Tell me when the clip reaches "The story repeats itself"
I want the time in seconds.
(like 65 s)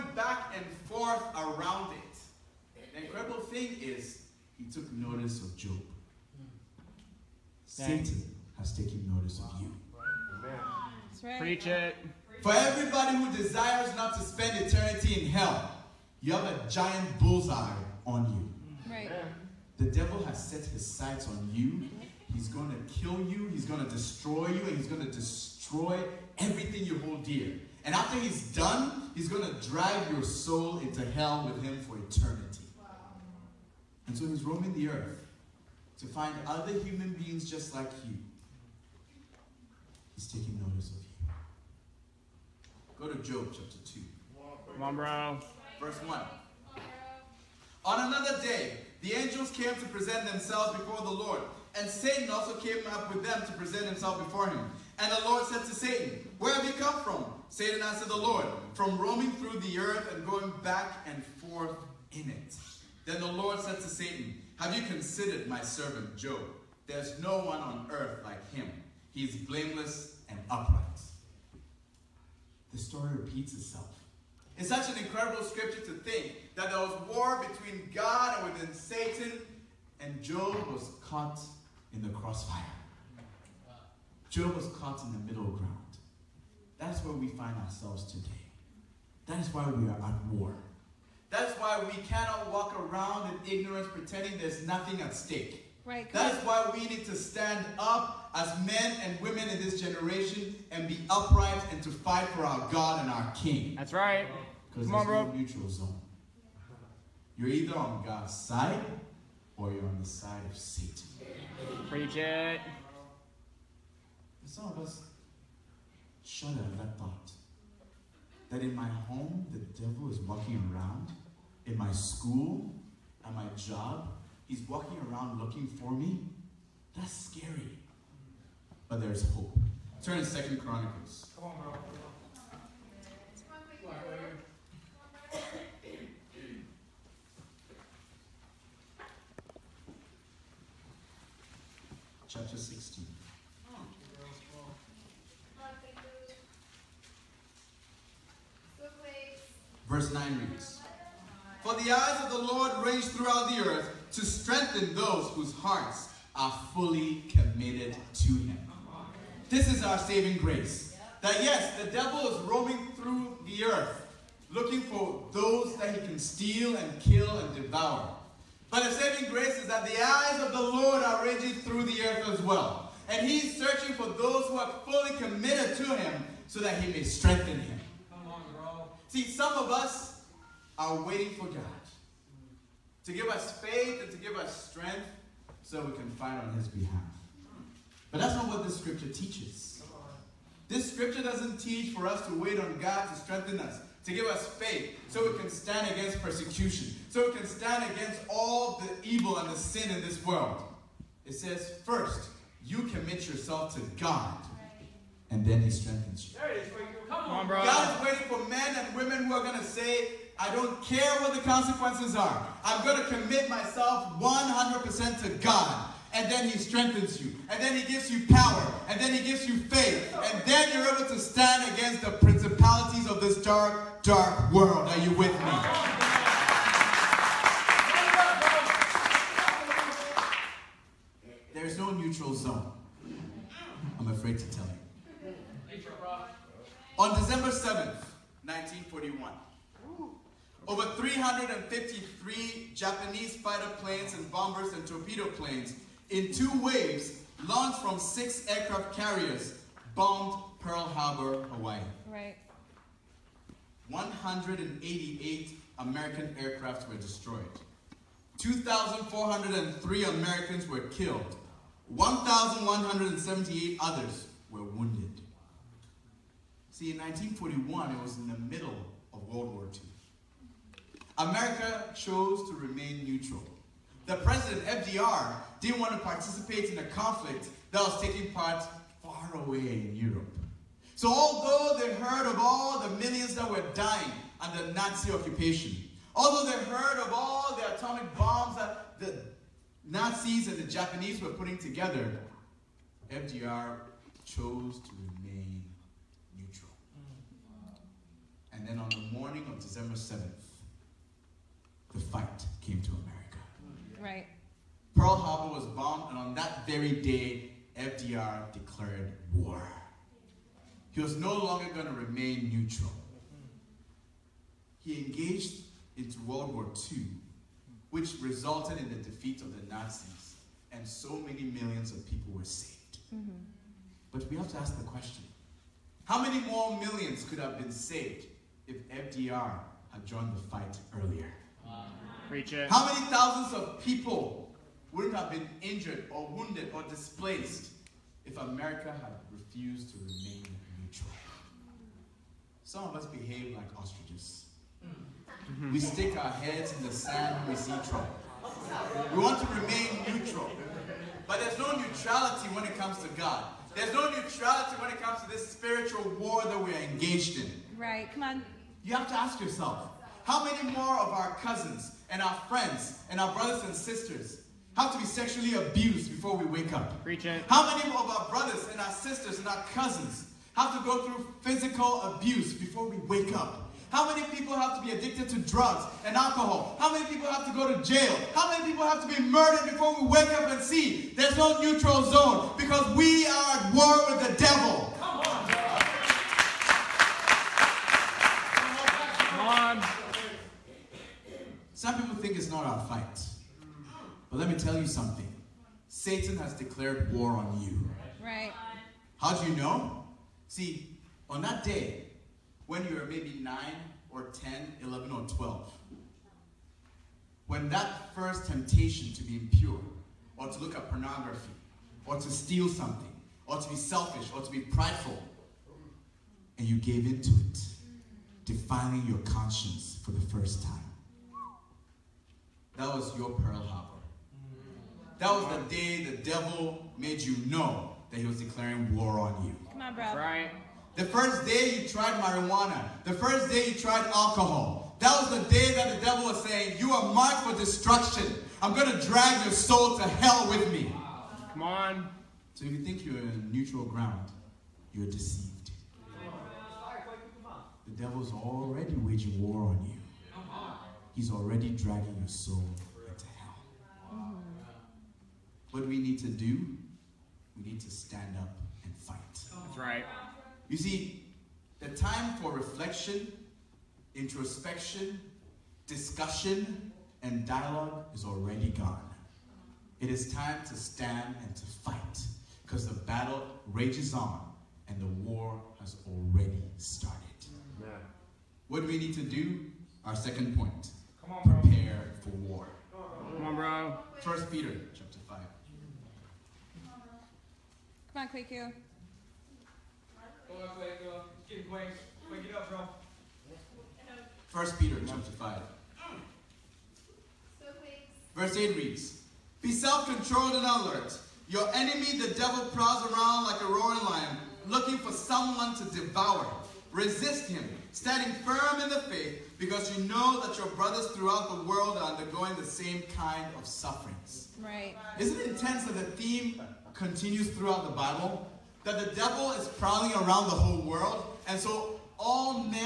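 72 s.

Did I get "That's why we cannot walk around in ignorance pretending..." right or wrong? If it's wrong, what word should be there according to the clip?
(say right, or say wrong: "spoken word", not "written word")
right.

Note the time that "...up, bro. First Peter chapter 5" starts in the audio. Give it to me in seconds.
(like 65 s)
492 s.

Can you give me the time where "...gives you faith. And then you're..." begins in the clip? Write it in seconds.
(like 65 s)
219 s.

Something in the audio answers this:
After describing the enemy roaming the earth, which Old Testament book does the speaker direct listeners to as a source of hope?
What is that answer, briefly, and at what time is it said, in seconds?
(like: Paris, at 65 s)
Second Chronicles, at 130 s.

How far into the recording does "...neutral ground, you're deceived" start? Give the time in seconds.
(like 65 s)
443 s.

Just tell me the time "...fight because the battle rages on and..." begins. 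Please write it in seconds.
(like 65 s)
471 s.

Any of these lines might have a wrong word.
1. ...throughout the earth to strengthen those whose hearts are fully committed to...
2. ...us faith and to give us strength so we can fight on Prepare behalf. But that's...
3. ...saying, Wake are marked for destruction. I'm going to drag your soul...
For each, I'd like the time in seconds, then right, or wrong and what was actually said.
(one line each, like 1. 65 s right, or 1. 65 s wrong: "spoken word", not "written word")
1. 153 s right
2. 183 s wrong: "His", not "Prepare"
3. 436 s wrong: "You", not "Wake".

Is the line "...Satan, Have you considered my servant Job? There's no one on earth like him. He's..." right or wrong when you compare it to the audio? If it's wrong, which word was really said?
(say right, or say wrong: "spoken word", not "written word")
right.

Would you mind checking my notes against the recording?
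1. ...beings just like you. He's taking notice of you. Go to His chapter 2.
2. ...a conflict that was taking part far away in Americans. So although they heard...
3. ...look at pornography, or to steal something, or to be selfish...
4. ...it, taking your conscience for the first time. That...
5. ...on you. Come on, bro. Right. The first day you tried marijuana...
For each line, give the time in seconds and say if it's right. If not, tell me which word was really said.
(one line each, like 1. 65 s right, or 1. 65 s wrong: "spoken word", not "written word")
1. 37 s wrong: "Job", not "His"
2. 276 s wrong: "Europe", not "Americans"
3. 410 s right
4. 417 s wrong: "defiling", not "taking"
5. 429 s right.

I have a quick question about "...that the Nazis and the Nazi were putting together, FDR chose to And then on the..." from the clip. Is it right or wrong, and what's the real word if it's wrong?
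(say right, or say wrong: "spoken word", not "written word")
wrong: "Japanese", not "Nazi".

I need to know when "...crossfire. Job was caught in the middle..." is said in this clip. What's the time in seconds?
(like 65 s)
82 s.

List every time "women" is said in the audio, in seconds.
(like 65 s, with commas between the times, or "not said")
99 s, 208 s.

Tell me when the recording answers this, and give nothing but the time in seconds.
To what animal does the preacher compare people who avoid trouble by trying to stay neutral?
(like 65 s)
343 s.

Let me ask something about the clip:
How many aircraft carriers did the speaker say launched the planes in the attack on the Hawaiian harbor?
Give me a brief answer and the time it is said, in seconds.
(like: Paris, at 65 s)
6, at 247 s.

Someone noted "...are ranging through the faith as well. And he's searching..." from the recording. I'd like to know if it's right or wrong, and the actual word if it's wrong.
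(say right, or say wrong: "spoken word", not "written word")
wrong: "earth", not "faith".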